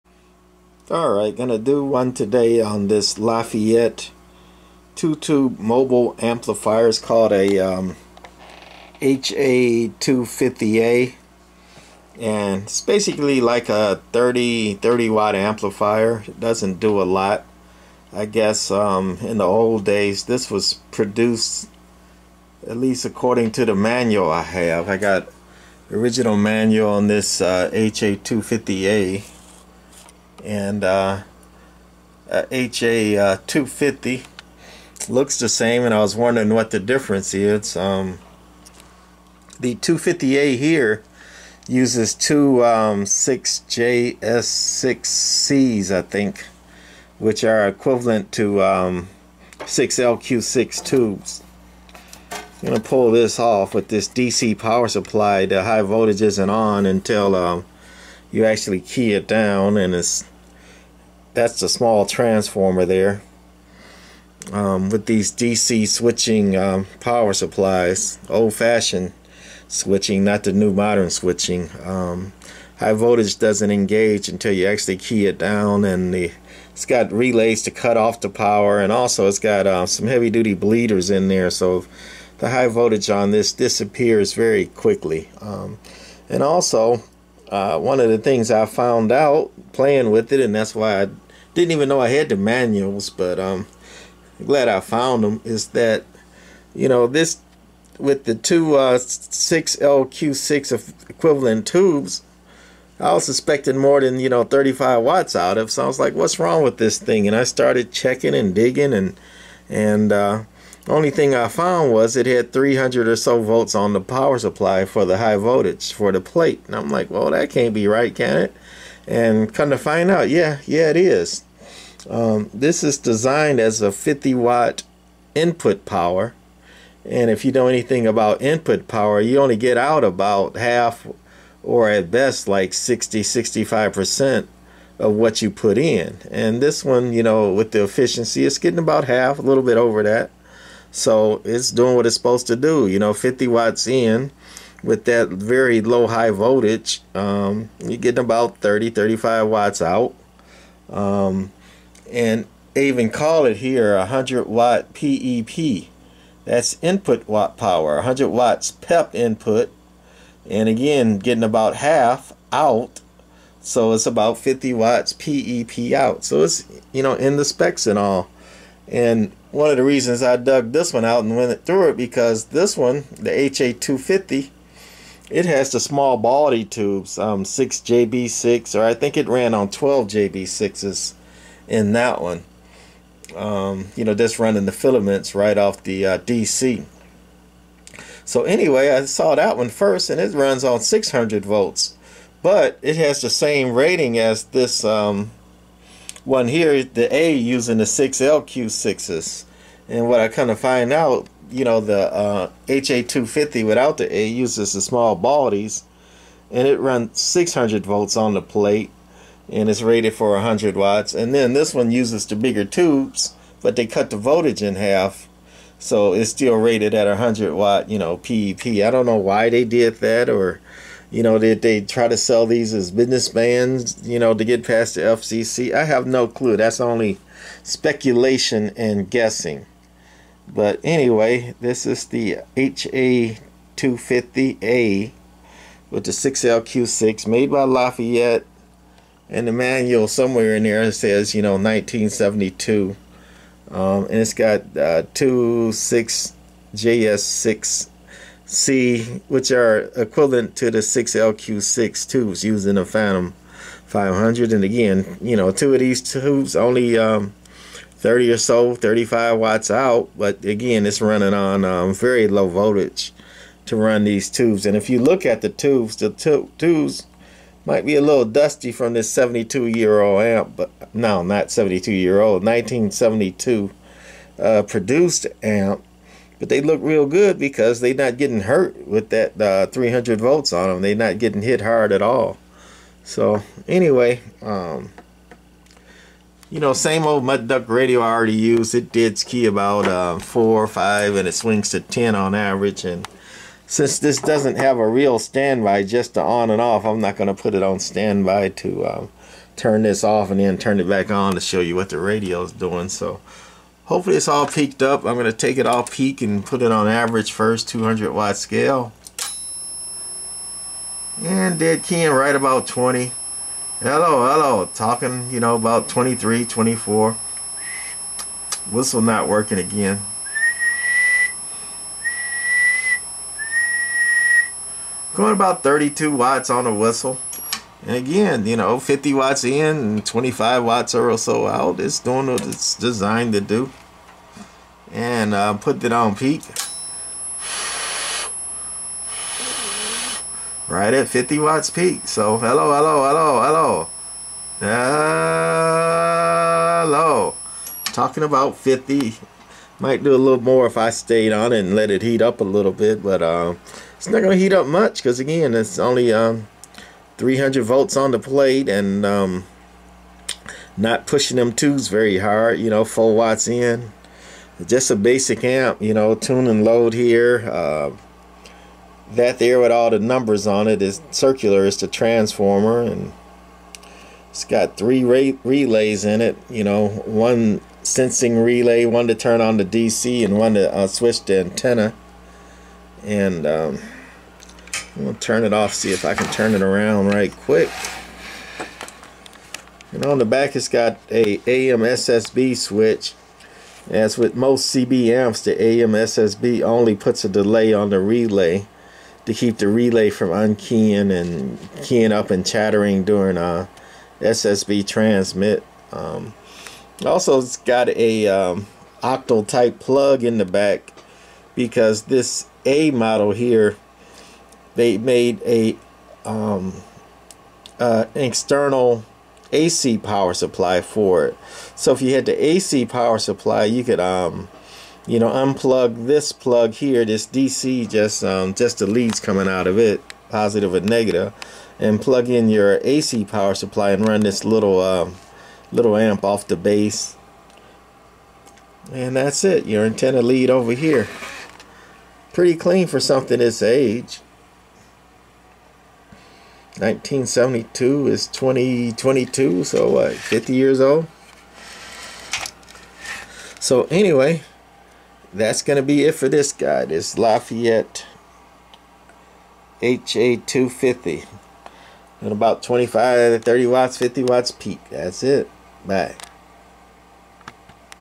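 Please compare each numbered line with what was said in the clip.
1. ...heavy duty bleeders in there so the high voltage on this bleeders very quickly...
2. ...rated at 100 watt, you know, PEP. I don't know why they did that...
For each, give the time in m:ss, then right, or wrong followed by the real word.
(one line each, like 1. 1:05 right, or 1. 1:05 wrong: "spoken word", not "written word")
1. 1:20 wrong: "disappears", not "bleeders"
2. 3:36 right.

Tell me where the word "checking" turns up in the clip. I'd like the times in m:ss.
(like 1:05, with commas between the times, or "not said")
1:47.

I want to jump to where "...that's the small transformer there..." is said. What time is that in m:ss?
1:01.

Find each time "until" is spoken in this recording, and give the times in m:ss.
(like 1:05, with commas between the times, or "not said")
0:56, 1:14.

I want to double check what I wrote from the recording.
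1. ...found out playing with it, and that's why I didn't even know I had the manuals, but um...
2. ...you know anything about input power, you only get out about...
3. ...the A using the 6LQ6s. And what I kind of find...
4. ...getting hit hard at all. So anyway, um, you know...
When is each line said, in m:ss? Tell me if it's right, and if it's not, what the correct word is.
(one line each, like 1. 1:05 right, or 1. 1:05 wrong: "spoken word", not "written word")
1. 1:28 right
2. 2:07 right
3. 3:16 right
4. 4:41 right.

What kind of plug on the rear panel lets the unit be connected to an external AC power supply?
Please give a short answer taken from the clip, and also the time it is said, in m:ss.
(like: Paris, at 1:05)
octal type plug, at 6:49.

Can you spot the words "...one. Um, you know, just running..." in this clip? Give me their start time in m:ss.
3:02.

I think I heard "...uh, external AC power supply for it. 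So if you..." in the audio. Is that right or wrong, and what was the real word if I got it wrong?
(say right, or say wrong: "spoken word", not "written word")
right.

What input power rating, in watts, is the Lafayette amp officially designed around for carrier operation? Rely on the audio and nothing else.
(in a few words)
50 watt.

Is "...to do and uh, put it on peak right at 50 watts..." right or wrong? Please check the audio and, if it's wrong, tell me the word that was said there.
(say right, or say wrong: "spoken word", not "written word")
right.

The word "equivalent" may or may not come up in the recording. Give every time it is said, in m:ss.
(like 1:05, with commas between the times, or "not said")
0:47, 1:41, 4:09.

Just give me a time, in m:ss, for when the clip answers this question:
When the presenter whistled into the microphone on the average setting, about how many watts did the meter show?
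5:25.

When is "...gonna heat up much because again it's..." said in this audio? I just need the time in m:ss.
5:54.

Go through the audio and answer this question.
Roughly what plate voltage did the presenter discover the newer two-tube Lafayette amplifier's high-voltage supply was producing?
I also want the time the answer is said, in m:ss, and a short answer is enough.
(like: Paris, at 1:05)
300 volts, at 1:52.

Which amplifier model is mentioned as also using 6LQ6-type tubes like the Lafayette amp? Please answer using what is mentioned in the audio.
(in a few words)
Phantom 500.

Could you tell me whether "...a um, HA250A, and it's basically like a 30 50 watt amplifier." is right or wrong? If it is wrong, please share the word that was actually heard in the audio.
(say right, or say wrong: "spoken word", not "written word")
wrong: "30", not "50".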